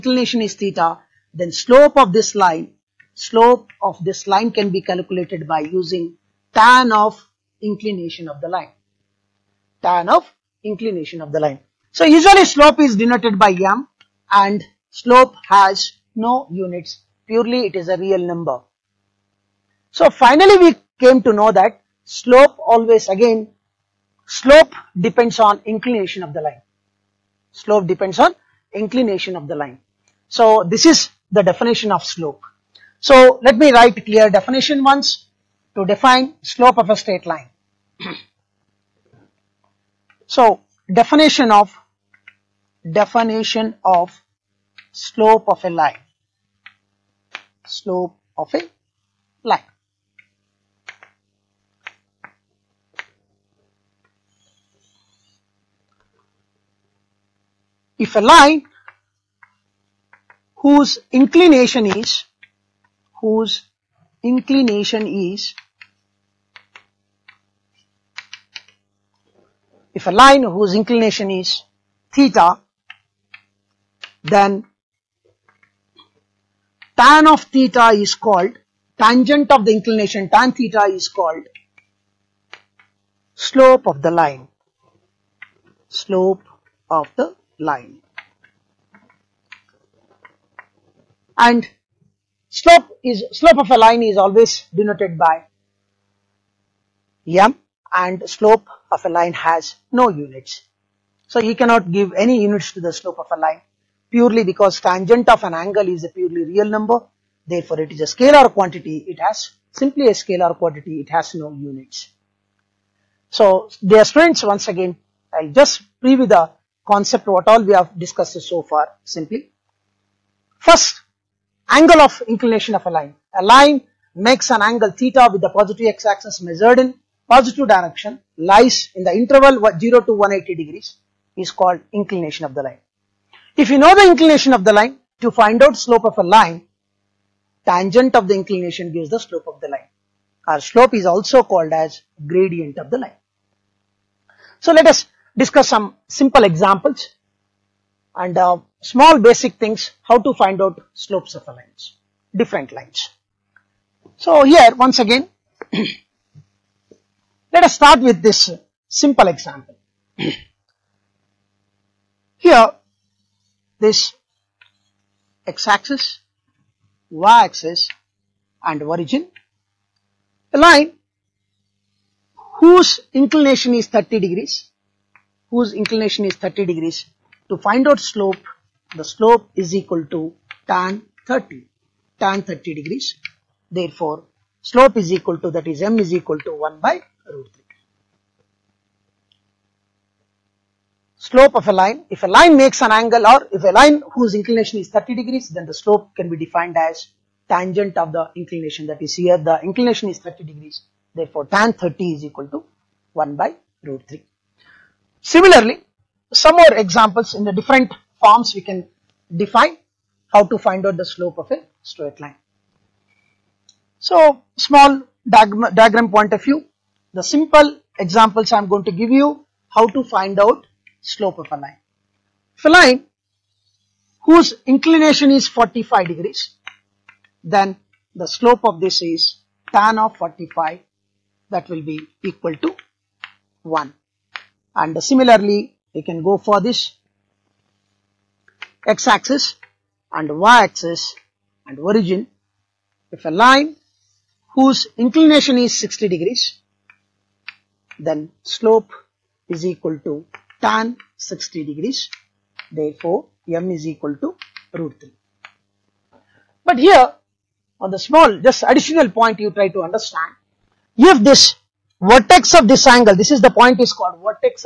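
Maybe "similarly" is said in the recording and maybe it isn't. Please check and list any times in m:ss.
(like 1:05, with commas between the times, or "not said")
3:25, 3:55.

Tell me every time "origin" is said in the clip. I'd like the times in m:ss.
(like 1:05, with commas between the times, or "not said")
2:48, 4:01.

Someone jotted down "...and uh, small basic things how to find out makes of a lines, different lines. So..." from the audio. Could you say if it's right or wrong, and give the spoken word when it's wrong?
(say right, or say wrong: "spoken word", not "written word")
wrong: "slopes", not "makes".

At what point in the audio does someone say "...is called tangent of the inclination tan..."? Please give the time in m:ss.
1:18.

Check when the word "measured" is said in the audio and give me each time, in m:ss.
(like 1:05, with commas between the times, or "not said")
2:06.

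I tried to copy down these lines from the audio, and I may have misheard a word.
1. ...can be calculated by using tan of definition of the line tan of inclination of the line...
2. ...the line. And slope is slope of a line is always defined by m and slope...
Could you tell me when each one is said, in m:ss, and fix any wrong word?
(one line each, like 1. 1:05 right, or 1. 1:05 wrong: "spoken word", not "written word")
1. 0:04 wrong: "inclination", not "definition"
2. 1:27 wrong: "denoted", not "defined".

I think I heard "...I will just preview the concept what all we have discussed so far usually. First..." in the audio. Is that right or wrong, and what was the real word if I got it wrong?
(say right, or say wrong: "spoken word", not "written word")
wrong: "simply", not "usually".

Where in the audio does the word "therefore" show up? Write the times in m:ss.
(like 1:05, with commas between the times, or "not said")
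1:47, 3:03, 3:21, 4:12.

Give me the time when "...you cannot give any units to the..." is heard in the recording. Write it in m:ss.
1:41.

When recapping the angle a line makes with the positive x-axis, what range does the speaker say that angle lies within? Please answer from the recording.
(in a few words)
0 to 180 degrees.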